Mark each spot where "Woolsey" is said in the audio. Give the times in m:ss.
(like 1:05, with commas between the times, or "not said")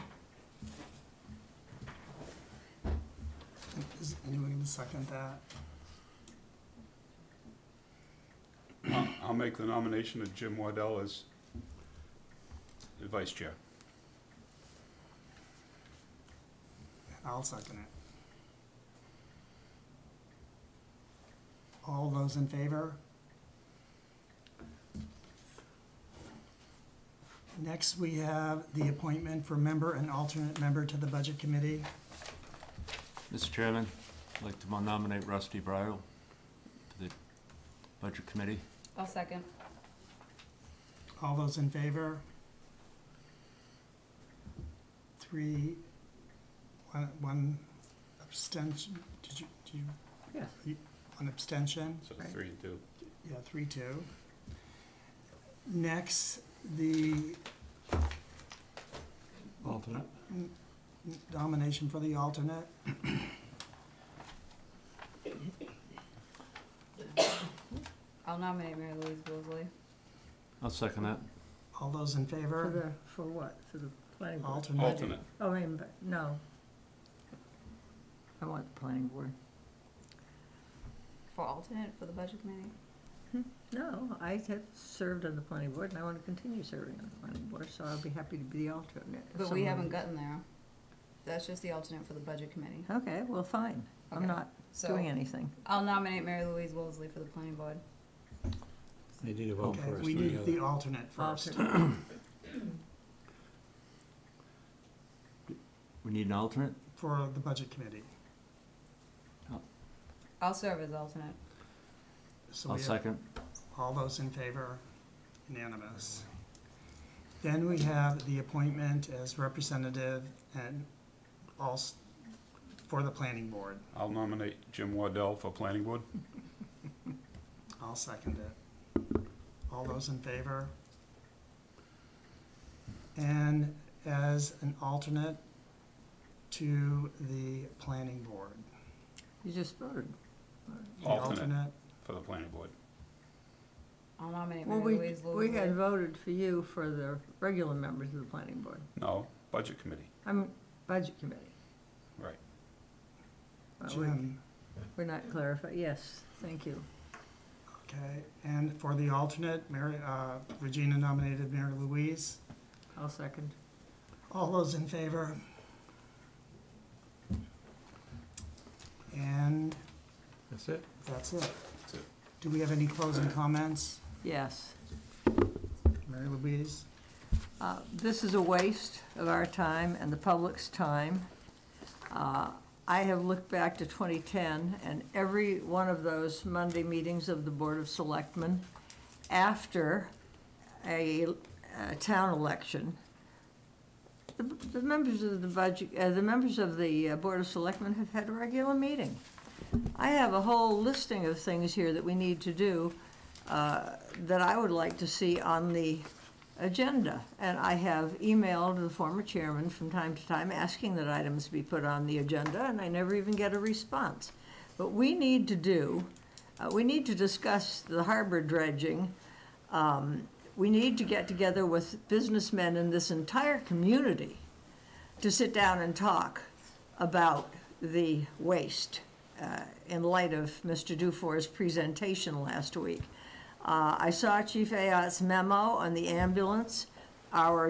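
1:09, 1:36.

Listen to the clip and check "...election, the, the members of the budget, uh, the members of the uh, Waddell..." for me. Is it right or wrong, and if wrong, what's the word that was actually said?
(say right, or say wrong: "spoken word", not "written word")
wrong: "Board", not "Waddell".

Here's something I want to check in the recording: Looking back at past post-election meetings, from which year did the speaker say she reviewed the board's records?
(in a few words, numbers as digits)
2010.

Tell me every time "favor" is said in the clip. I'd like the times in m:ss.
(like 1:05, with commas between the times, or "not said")
0:22, 0:41, 1:12, 1:54, 2:10, 2:44.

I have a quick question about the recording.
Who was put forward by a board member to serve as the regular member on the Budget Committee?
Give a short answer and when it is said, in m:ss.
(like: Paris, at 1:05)
Rusty Bridle, at 0:35.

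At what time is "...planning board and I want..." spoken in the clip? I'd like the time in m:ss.
1:25.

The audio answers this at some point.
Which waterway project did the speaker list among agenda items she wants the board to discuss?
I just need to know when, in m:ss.
3:38.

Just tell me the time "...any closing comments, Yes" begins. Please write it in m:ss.
2:52.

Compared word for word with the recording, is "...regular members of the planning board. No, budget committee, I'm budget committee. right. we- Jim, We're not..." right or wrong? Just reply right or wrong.
right.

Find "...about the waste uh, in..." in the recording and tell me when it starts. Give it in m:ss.
3:46.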